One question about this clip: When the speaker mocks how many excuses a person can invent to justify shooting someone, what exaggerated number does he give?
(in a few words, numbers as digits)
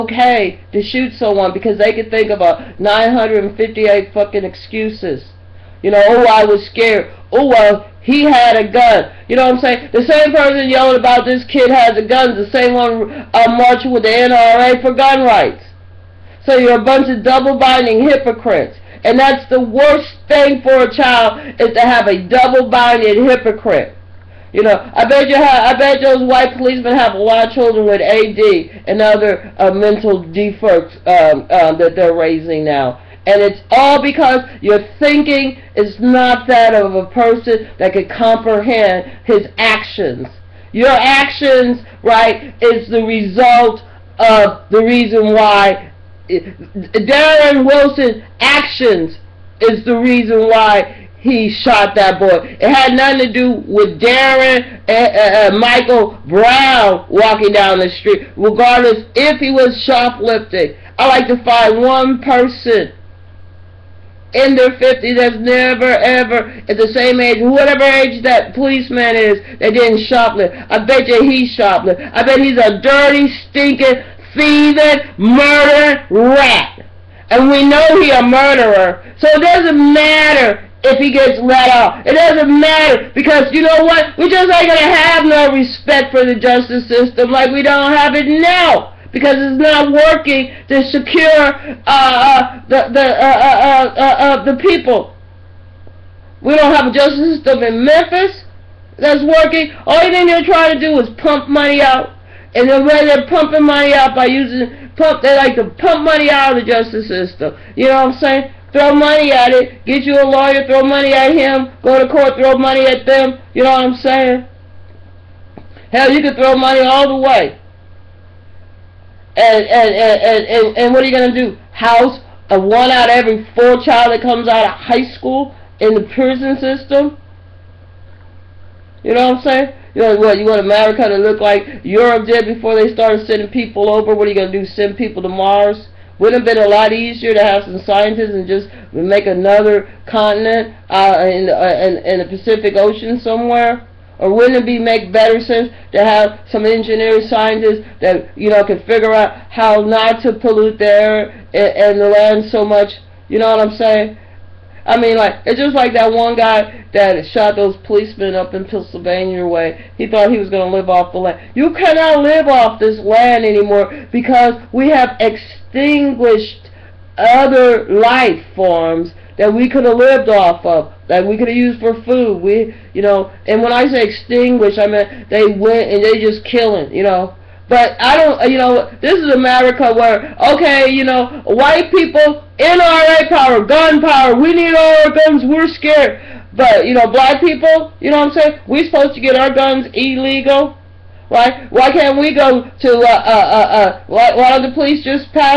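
958.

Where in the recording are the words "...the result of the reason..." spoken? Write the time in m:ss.
0:42.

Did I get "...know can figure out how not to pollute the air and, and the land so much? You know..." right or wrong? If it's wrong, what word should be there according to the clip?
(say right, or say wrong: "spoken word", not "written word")
right.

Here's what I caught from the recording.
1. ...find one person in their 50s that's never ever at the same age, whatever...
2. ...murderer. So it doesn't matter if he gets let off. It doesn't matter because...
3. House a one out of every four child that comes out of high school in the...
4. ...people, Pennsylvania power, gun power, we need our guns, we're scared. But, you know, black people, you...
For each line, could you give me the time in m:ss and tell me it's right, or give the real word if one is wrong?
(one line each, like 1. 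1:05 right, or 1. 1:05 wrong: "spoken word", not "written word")
1. 1:01 right
2. 1:18 right
3. 2:01 right
4. 3:01 wrong: "NRA", not "Pennsylvania".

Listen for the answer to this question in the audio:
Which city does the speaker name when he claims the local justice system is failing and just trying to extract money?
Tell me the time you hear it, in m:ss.
1:37.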